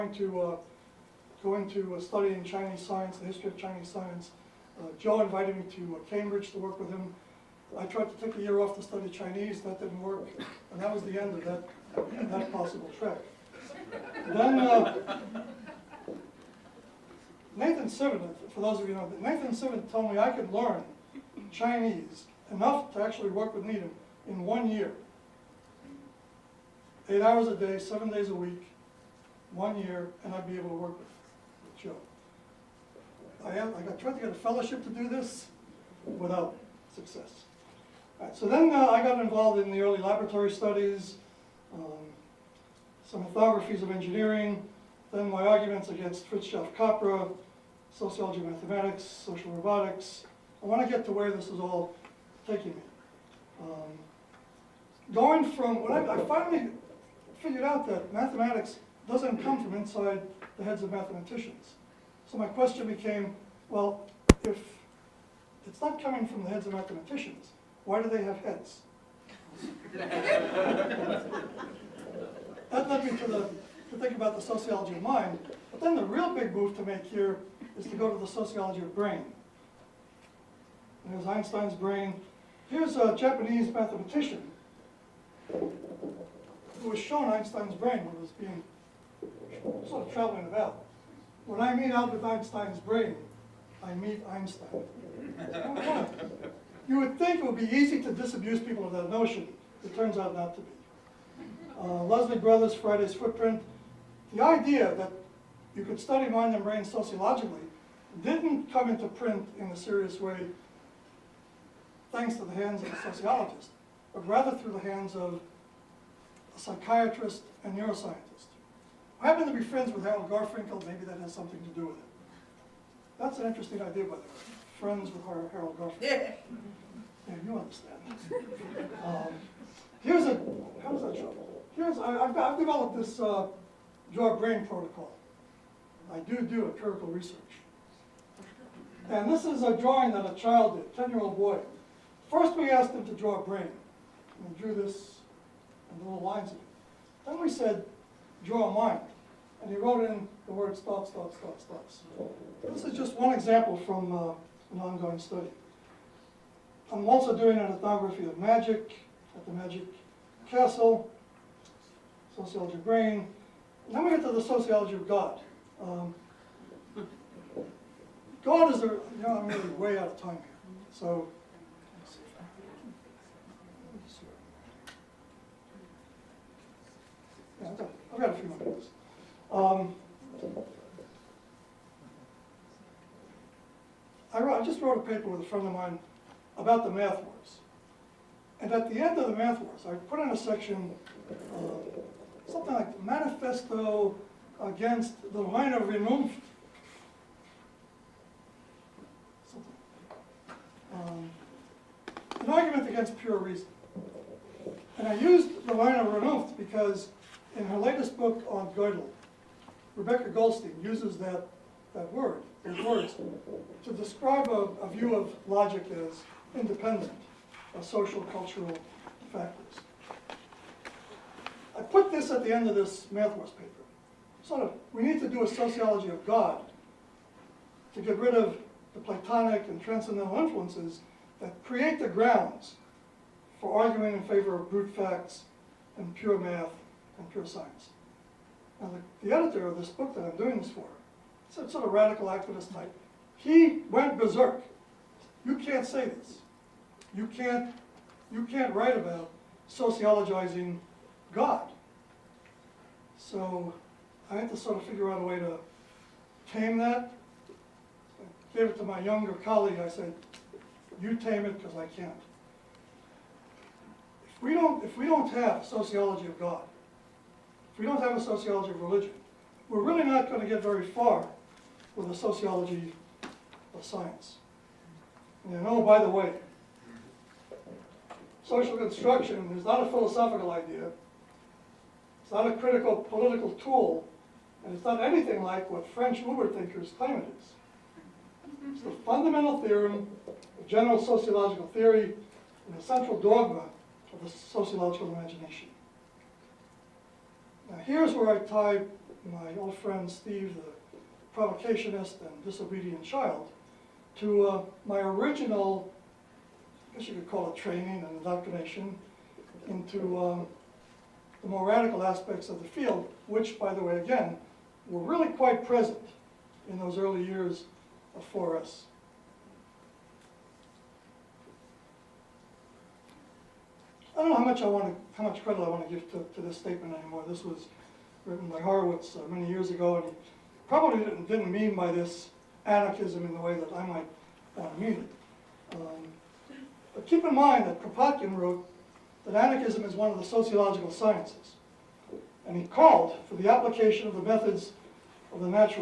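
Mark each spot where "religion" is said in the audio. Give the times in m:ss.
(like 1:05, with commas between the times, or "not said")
4:28.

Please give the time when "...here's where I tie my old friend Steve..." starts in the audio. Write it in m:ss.
4:57.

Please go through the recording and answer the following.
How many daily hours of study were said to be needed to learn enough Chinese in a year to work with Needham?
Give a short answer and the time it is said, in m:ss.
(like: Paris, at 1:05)
8, at 0:27.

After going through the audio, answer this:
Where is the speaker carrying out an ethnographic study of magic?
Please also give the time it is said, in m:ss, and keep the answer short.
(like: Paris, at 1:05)
Magic Castle, at 2:39.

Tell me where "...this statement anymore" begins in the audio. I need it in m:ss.
5:26.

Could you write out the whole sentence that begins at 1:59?
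I happen to be friends with Harold Garfinkel, maybe that has something to do with it.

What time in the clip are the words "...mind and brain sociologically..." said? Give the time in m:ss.
1:46.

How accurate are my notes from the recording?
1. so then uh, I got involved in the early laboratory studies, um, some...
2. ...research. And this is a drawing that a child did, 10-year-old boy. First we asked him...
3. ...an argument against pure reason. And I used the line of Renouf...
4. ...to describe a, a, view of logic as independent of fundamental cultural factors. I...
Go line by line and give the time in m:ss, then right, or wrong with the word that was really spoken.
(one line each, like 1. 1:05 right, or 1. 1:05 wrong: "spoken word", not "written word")
1. 0:38 right
2. 2:17 right
3. 3:22 right
4. 3:33 wrong: "social", not "fundamental".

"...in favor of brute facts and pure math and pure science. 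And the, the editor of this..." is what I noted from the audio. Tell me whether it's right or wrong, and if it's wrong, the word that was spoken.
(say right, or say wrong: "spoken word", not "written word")
right.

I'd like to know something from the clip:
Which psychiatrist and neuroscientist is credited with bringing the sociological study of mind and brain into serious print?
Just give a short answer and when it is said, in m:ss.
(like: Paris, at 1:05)
Leslie Brothers, at 1:42.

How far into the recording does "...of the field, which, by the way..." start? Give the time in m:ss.
5:12.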